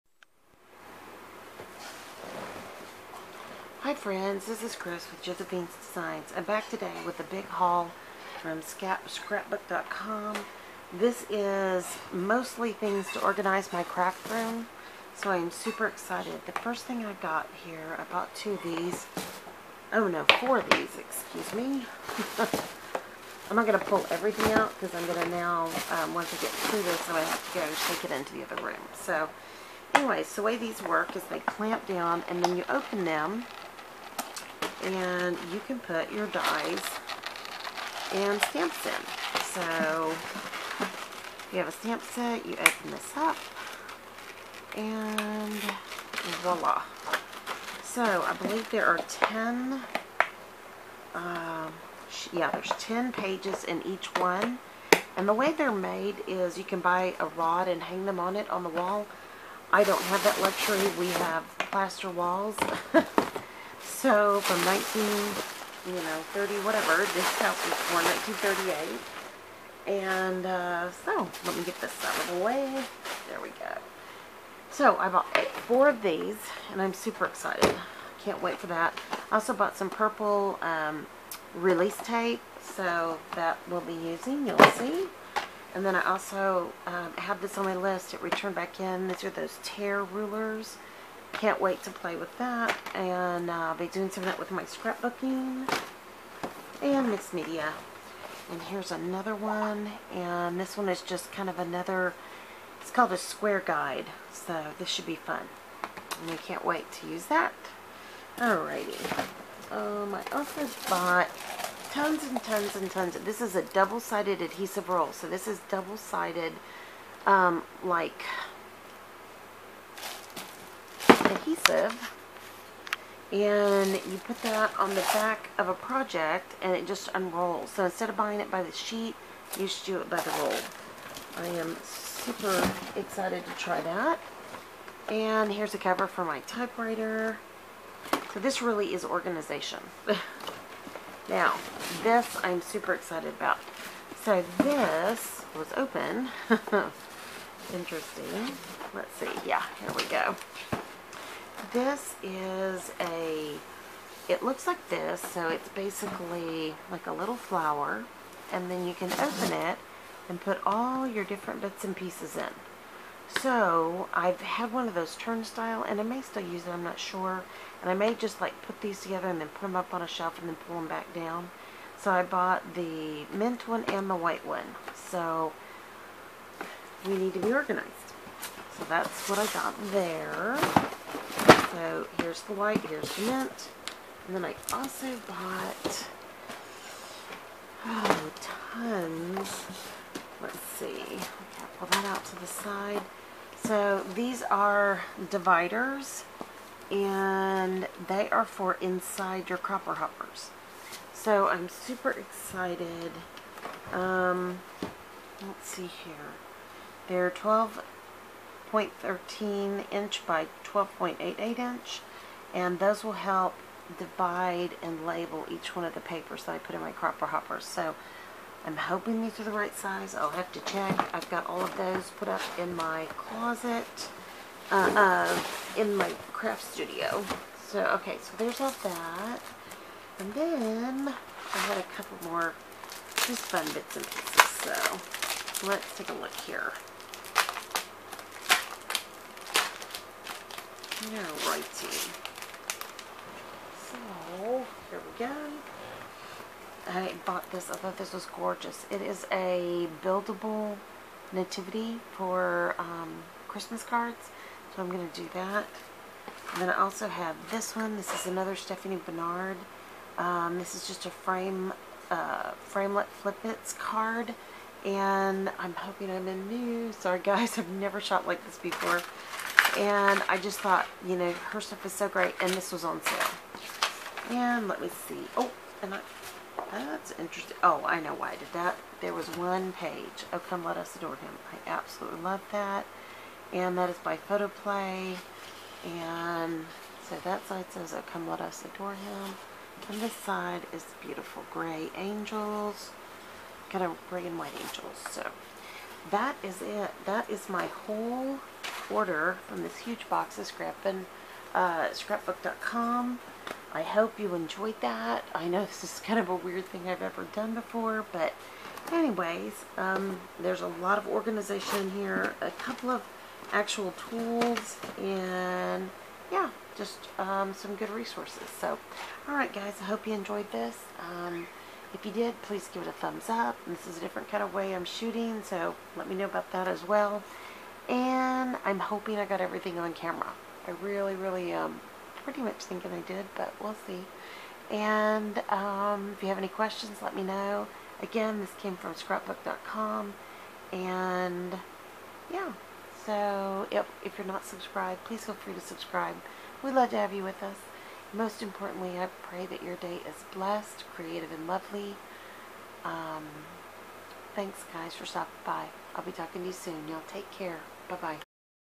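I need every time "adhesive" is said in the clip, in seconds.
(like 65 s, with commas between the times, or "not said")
114 s, 121 s.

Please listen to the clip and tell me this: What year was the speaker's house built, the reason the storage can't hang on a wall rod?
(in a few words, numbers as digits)
1938.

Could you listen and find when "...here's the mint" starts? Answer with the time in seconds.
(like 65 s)
182 s.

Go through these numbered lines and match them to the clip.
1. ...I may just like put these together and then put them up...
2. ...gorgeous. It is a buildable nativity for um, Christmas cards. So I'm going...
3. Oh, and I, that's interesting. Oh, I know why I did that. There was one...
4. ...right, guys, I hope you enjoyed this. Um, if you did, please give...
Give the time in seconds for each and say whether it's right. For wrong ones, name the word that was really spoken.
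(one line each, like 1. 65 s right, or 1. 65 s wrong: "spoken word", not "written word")
1. 167 s right
2. 248 s right
3. 275 s right
4. 319 s right.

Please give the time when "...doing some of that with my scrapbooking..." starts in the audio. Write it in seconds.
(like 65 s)
93 s.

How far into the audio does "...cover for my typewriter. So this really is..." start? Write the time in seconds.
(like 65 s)
135 s.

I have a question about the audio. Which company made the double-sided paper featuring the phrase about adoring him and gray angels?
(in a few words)
Photoplay.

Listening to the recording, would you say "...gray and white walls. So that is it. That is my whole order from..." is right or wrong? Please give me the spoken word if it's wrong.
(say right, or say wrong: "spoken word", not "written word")
wrong: "angels", not "walls".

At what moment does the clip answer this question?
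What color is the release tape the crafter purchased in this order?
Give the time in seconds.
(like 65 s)
79 s.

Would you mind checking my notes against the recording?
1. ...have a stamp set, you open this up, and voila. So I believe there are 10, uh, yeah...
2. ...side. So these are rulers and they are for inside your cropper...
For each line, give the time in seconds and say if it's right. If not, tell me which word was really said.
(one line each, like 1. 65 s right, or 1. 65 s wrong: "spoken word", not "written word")
1. 41 s right
2. 192 s wrong: "dividers", not "rulers".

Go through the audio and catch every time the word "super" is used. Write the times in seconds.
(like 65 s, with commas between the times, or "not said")
15 s, 76 s, 131 s, 142 s, 201 s.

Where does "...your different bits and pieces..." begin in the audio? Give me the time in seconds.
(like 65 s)
161 s.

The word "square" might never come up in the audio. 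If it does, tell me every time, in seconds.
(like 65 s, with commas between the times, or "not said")
103 s.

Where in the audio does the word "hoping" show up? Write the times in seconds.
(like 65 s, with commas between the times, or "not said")
218 s, 265 s, 328 s.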